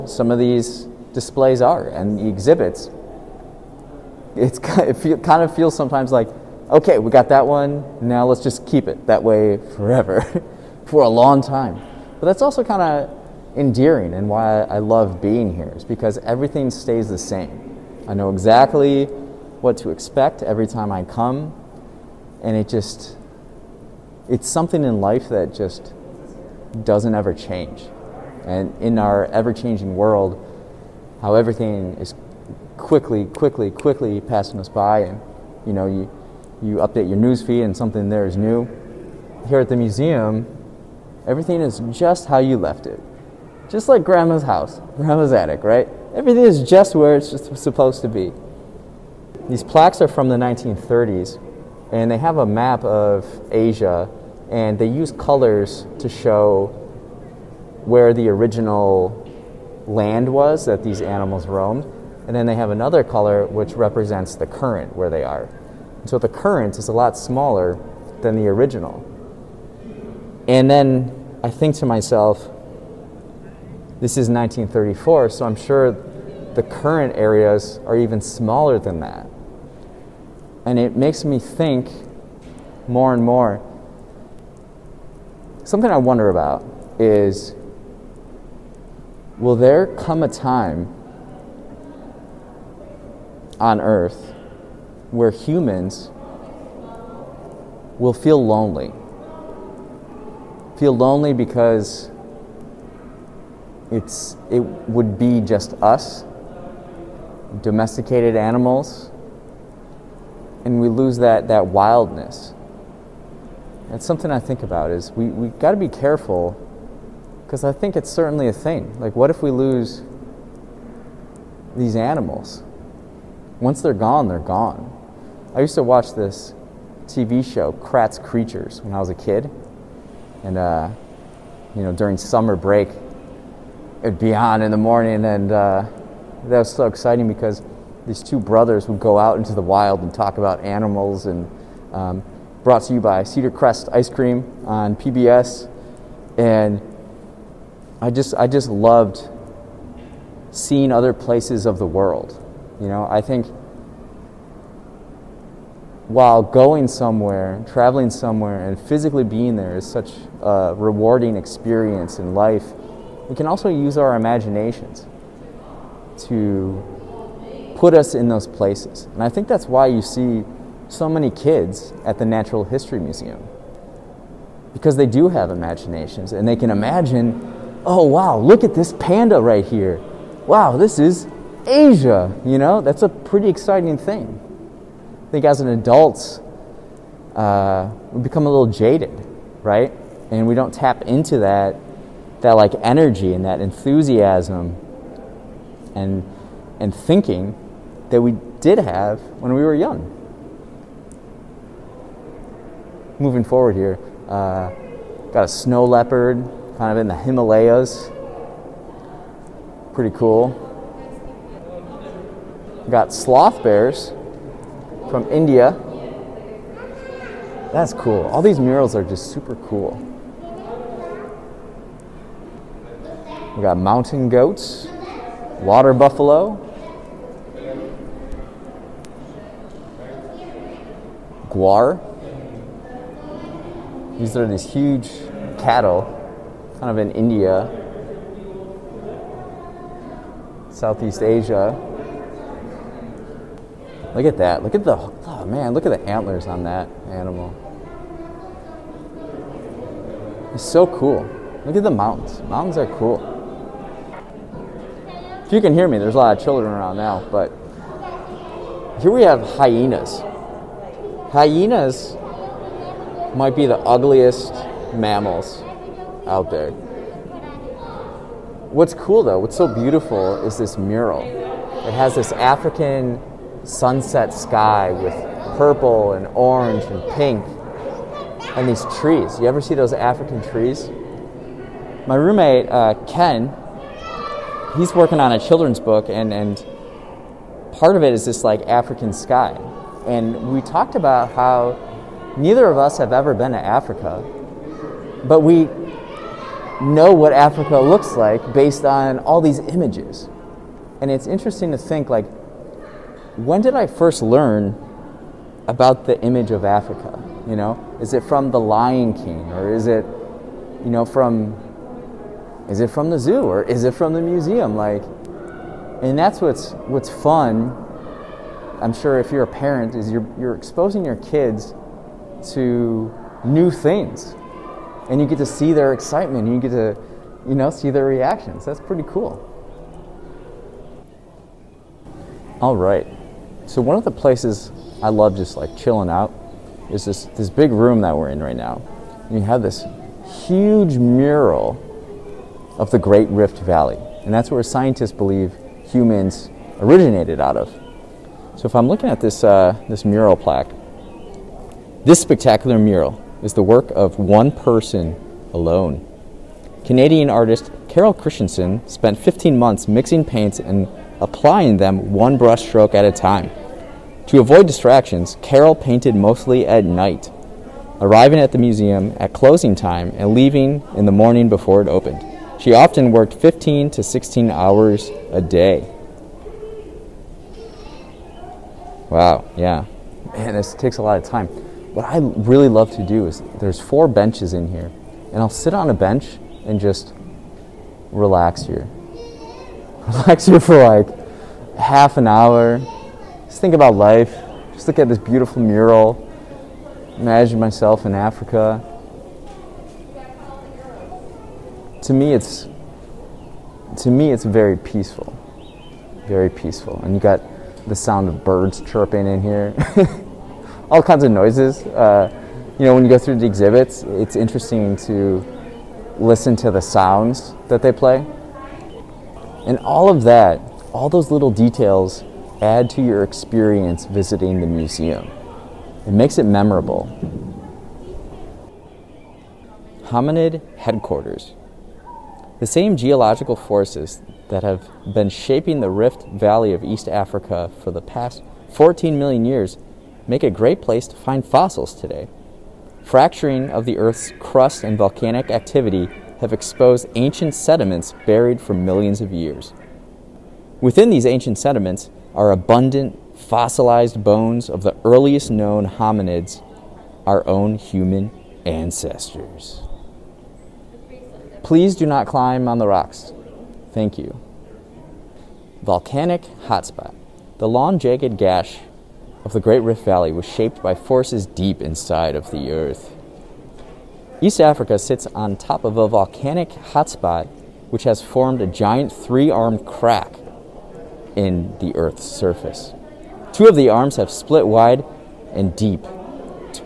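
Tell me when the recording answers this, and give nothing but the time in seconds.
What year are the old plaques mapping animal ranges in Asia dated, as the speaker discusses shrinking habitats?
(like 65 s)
74 s.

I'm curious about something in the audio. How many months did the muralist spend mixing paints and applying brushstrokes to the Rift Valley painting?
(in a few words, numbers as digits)
15 months.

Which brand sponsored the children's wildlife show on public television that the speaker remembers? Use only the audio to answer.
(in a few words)
Cedar Crest Ice Cream.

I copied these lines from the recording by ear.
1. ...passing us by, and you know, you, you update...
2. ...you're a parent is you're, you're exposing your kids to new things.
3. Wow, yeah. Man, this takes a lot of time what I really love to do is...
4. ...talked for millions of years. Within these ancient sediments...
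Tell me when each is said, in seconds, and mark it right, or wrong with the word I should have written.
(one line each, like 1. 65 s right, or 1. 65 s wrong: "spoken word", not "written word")
1. 34 s right
2. 319 s right
3. 379 s right
4. 448 s wrong: "buried", not "talked".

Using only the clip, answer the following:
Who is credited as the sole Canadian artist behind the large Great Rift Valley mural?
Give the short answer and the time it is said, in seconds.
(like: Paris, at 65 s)
Carol Christensen, at 357 s.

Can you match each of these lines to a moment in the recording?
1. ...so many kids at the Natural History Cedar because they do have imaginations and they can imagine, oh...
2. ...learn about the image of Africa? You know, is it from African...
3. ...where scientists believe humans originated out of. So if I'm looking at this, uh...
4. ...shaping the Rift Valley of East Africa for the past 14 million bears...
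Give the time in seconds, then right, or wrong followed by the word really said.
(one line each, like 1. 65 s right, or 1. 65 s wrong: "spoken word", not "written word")
1. 170 s wrong: "Museum", not "Cedar"
2. 304 s wrong: "The", not "African"
3. 344 s right
4. 435 s wrong: "years", not "bears".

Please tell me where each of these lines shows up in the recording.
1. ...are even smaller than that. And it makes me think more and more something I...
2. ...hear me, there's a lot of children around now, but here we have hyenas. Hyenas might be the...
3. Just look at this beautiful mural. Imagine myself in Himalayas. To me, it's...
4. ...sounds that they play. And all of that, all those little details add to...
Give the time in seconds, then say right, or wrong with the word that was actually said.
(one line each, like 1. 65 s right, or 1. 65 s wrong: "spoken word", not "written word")
1. 77 s right
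2. 255 s right
3. 394 s wrong: "Africa", not "Himalayas"
4. 416 s right.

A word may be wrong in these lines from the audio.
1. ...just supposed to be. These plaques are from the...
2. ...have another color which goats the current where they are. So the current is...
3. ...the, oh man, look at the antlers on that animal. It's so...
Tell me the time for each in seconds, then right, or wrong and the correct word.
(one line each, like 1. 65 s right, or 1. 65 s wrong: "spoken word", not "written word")
1. 47 s right
2. 62 s wrong: "represents", not "goats"
3. 244 s right.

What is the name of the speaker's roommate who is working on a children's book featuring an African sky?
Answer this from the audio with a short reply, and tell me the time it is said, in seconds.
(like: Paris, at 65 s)
Ken, at 283 s.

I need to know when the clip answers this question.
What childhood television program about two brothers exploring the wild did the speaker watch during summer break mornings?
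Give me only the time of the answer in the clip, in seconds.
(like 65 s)
127 s.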